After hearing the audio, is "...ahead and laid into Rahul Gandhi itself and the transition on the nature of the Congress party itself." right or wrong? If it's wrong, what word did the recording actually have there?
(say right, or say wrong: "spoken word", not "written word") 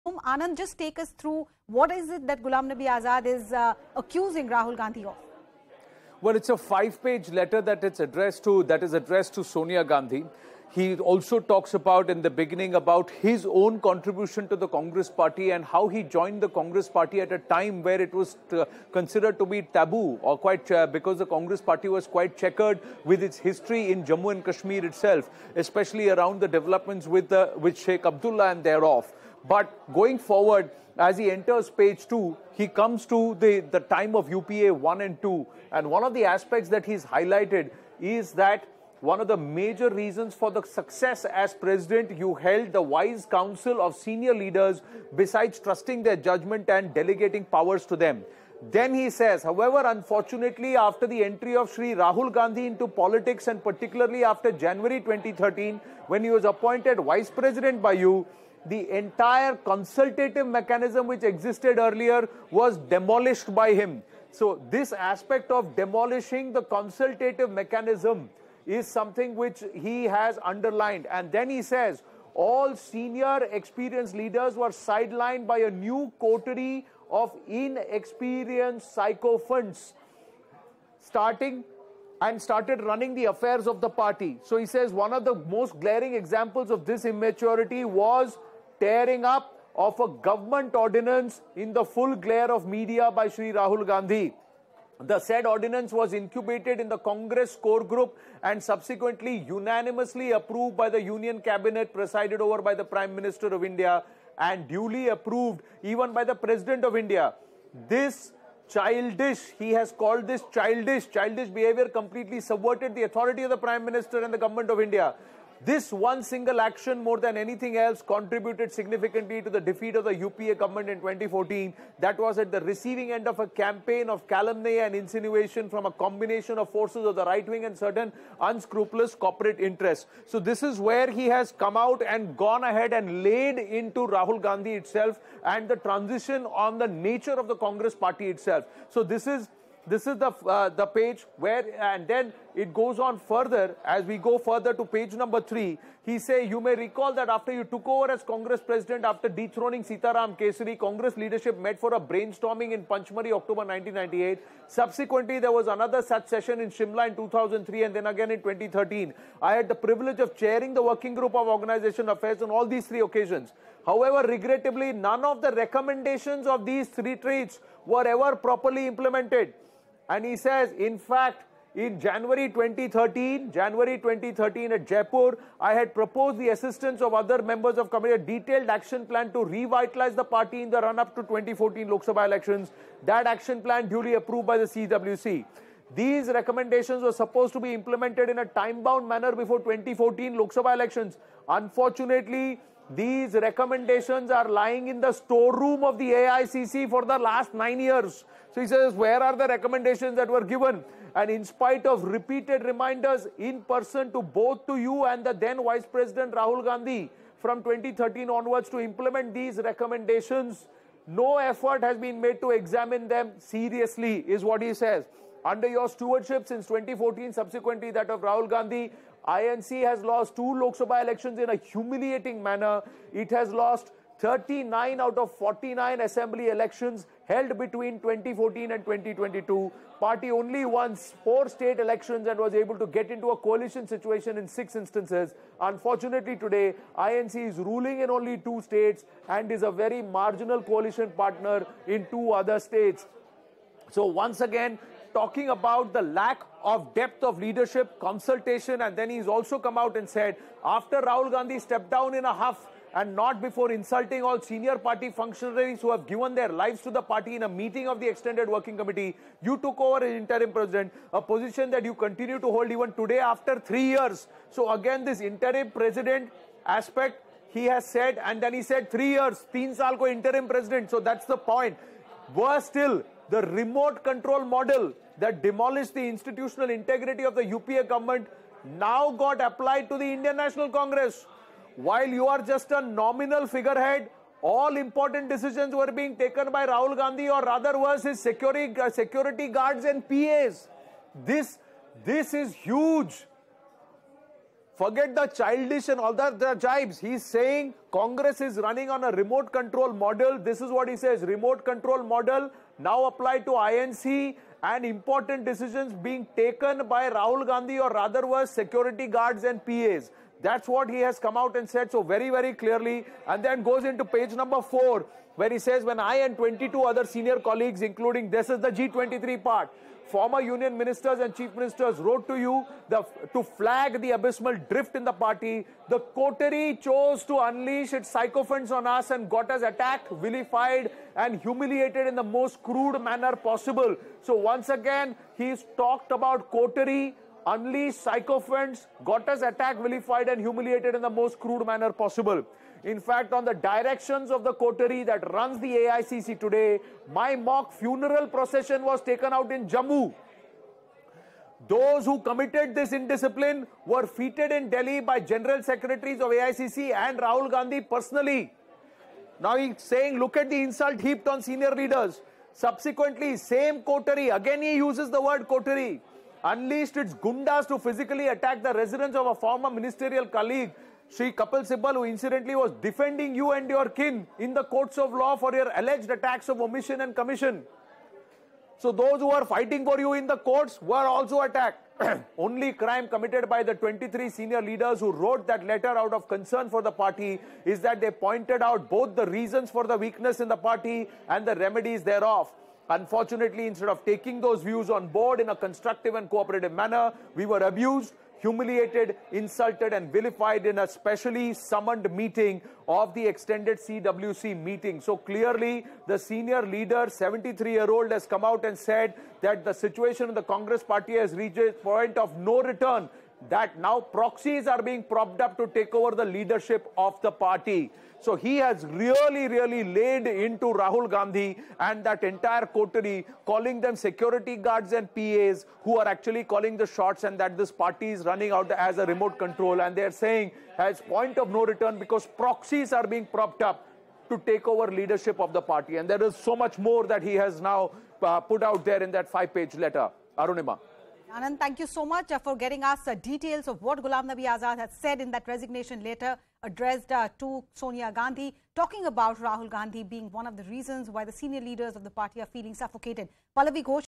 right.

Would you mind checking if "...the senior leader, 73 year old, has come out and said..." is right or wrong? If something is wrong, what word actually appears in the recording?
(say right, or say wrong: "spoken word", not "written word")
right.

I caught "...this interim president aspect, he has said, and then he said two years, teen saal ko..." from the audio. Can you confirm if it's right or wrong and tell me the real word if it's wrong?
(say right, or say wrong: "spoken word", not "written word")
wrong: "three", not "two".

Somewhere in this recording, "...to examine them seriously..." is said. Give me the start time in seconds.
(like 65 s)
212 s.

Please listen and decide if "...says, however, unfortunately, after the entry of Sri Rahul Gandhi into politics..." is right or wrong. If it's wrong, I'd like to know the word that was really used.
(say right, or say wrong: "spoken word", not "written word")
right.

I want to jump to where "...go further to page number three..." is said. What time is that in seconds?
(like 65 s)
144 s.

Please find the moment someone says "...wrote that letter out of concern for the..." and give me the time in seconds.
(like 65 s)
385 s.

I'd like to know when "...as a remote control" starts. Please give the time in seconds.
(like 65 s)
428 s.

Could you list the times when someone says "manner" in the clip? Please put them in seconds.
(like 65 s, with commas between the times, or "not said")
189 s, 222 s, 332 s, 341 s, 396 s.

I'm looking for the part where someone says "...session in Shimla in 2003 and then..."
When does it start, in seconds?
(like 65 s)
156 s.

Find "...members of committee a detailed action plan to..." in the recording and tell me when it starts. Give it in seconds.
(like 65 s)
177 s.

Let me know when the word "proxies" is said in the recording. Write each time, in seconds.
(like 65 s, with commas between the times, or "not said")
413 s, 432 s.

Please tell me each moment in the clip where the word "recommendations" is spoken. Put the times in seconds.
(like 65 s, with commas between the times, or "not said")
165 s, 186 s, 193 s, 199 s, 209 s.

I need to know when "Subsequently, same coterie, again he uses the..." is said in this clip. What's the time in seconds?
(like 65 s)
362 s.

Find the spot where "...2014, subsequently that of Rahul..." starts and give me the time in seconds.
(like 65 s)
216 s.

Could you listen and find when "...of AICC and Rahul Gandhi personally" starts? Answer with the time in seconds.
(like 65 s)
356 s.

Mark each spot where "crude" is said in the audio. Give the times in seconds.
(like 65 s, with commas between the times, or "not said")
332 s, 341 s.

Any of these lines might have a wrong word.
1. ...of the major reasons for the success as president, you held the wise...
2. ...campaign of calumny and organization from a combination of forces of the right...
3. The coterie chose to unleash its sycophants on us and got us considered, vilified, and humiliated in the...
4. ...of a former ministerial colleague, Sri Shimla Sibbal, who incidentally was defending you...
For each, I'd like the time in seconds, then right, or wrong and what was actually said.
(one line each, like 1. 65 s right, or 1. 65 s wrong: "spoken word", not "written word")
1. 39 s right
2. 123 s wrong: "insinuation", not "organization"
3. 325 s wrong: "attacked", not "considered"
4. 369 s wrong: "Kapil", not "Shimla".